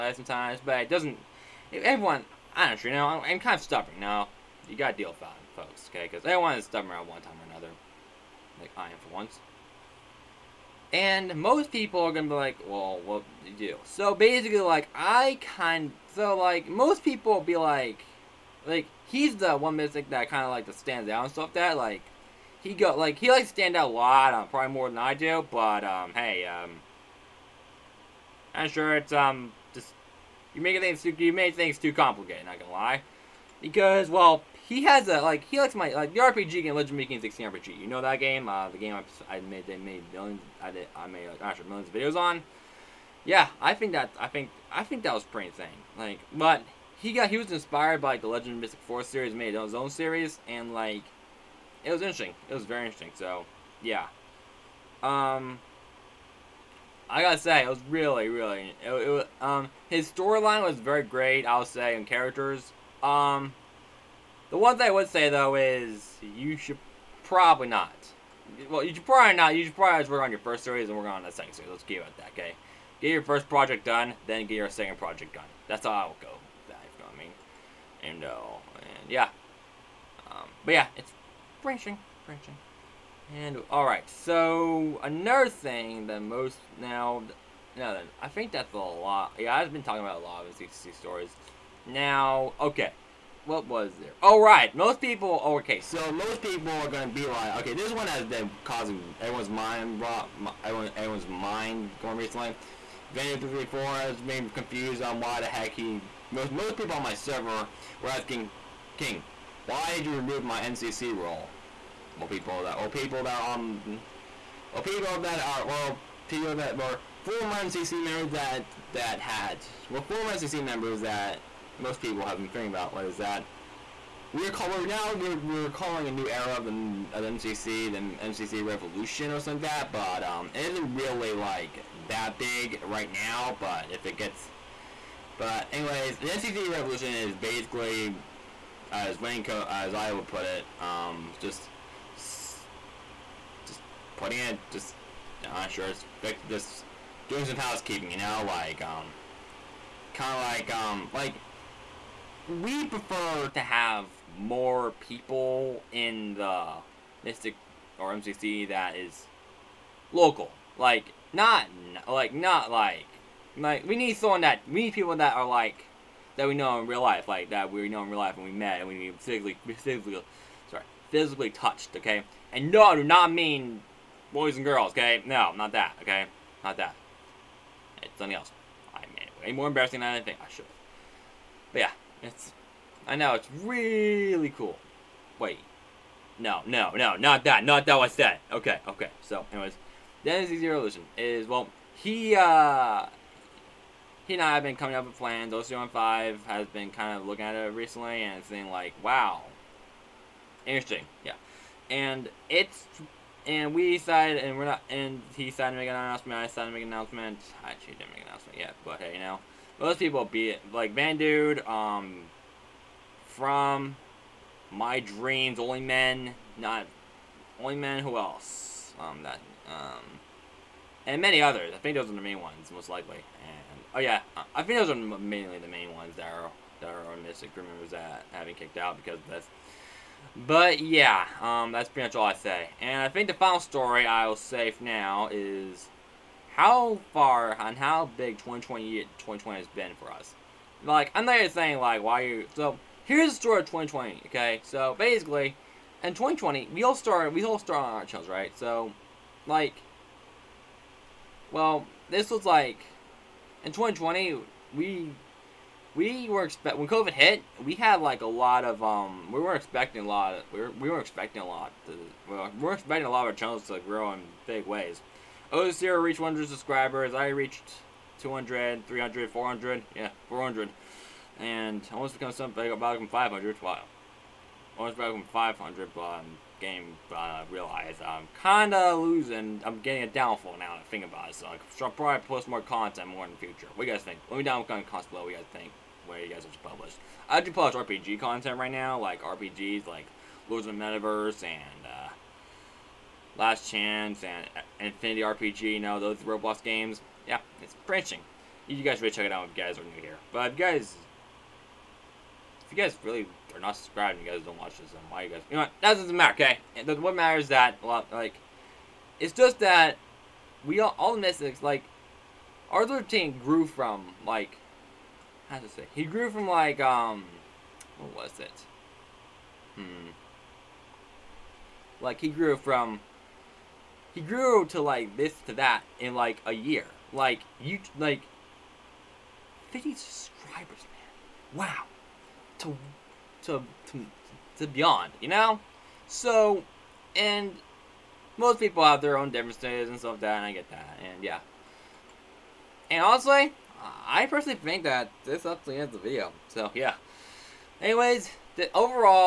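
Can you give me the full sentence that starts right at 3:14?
He and I have been coming up with plans.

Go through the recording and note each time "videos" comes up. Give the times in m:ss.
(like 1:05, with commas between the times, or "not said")
0:41, 5:45.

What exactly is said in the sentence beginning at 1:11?
Let's keep it at that, okay?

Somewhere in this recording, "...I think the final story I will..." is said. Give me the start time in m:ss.
3:53.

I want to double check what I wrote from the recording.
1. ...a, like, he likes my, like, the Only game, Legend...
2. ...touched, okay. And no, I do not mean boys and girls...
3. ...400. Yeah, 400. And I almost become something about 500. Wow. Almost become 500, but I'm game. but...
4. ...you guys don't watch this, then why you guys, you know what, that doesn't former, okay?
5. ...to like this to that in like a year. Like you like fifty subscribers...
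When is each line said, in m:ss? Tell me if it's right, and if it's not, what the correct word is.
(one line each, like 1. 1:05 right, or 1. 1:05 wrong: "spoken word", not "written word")
1. 0:35 wrong: "RPG", not "Only"
2. 2:51 right
3. 4:29 right
4. 5:04 wrong: "matter", not "former"
5. 5:24 right.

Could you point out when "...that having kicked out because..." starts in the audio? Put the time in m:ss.
3:47.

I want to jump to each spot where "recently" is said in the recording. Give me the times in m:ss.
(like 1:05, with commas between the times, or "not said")
1:42, 3:17.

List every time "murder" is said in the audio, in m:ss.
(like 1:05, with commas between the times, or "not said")
not said.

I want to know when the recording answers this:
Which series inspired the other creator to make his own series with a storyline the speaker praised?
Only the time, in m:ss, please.
0:48.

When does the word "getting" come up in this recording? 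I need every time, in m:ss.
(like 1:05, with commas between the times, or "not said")
4:39.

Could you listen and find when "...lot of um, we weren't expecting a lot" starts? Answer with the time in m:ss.
4:18.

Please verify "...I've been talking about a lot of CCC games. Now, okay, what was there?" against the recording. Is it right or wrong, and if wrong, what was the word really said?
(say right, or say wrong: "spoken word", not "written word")
wrong: "stories", not "games".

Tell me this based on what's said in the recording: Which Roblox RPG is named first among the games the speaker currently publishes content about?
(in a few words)
Lords of the Metaverse.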